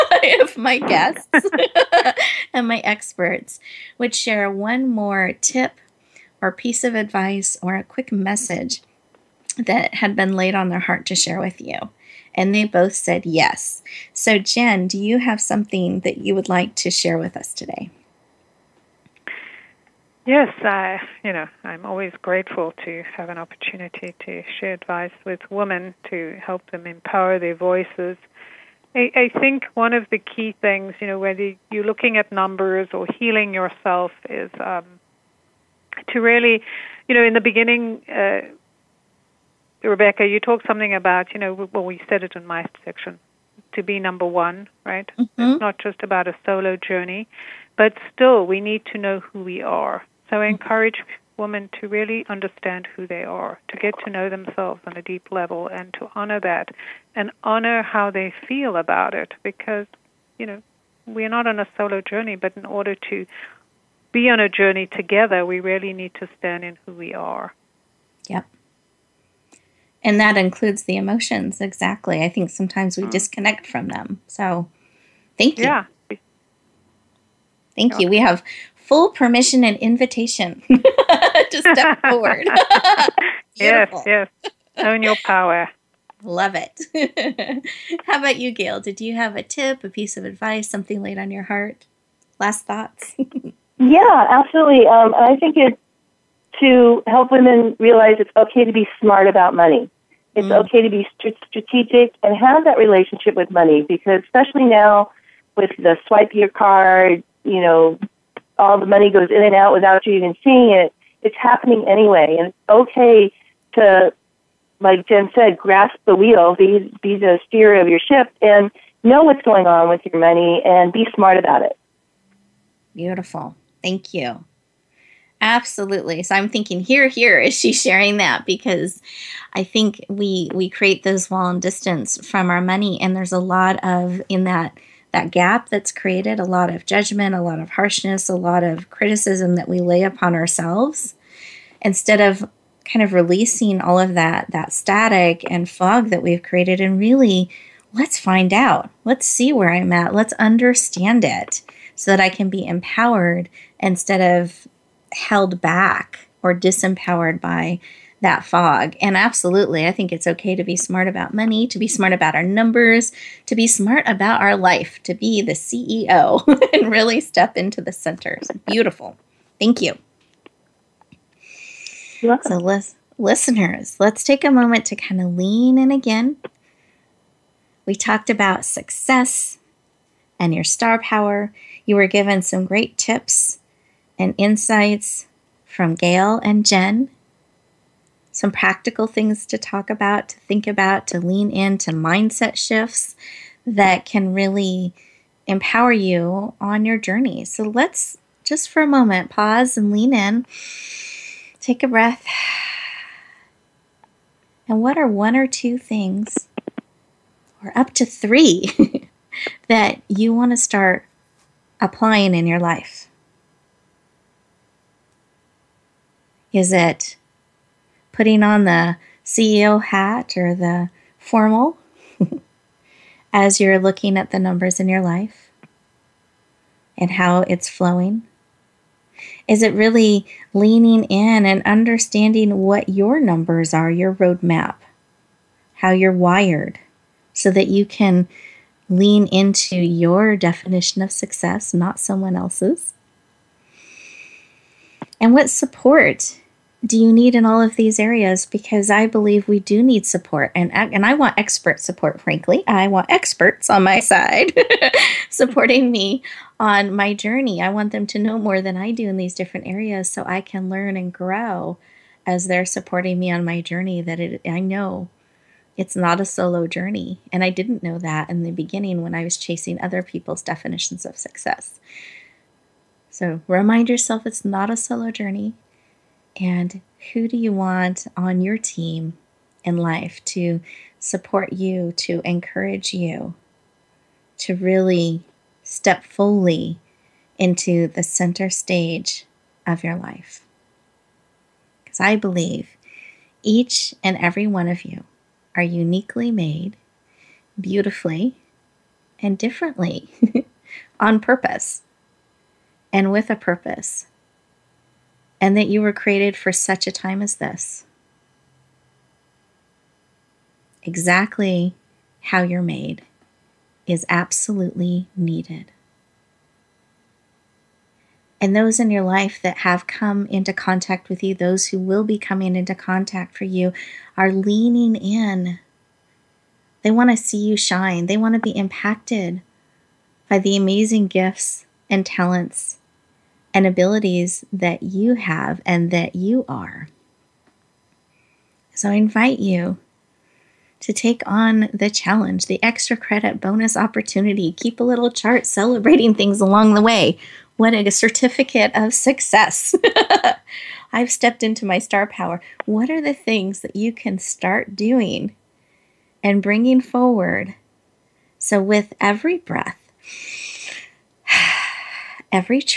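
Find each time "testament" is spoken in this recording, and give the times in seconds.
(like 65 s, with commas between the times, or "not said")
not said.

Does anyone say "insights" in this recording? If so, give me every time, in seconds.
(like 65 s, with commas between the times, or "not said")
184 s.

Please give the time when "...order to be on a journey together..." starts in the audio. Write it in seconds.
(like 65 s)
62 s.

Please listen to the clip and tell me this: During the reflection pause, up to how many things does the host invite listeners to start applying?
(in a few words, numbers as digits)
3.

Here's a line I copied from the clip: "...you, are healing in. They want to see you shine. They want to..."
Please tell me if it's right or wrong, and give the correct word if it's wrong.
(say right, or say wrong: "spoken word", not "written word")
wrong: "leaning", not "healing".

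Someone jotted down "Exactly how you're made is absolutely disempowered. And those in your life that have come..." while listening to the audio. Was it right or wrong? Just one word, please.
wrong.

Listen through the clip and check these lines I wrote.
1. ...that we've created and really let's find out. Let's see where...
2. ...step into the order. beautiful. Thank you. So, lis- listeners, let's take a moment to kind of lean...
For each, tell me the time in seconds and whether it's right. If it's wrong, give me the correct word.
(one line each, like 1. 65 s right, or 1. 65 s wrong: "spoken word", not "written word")
1. 146 s right
2. 167 s wrong: "center", not "order".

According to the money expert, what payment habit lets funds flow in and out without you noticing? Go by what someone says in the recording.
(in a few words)
swipe your card.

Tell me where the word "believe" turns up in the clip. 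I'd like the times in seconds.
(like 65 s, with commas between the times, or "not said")
249 s, 292 s.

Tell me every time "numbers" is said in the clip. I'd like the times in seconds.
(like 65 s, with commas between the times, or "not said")
32 s, 43 s, 162 s, 224 s, 233 s.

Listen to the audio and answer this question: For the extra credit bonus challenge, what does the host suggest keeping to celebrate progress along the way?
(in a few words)
a little chart.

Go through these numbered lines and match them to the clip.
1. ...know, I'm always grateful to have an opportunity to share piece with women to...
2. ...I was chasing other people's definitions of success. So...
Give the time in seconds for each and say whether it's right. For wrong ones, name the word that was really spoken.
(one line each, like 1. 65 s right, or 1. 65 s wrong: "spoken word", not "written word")
1. 21 s wrong: "advice", not "piece"
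2. 269 s right.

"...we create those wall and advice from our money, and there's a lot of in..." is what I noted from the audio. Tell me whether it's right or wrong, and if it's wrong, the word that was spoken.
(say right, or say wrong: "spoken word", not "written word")
wrong: "distance", not "advice".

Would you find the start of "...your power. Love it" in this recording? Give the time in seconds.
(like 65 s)
85 s.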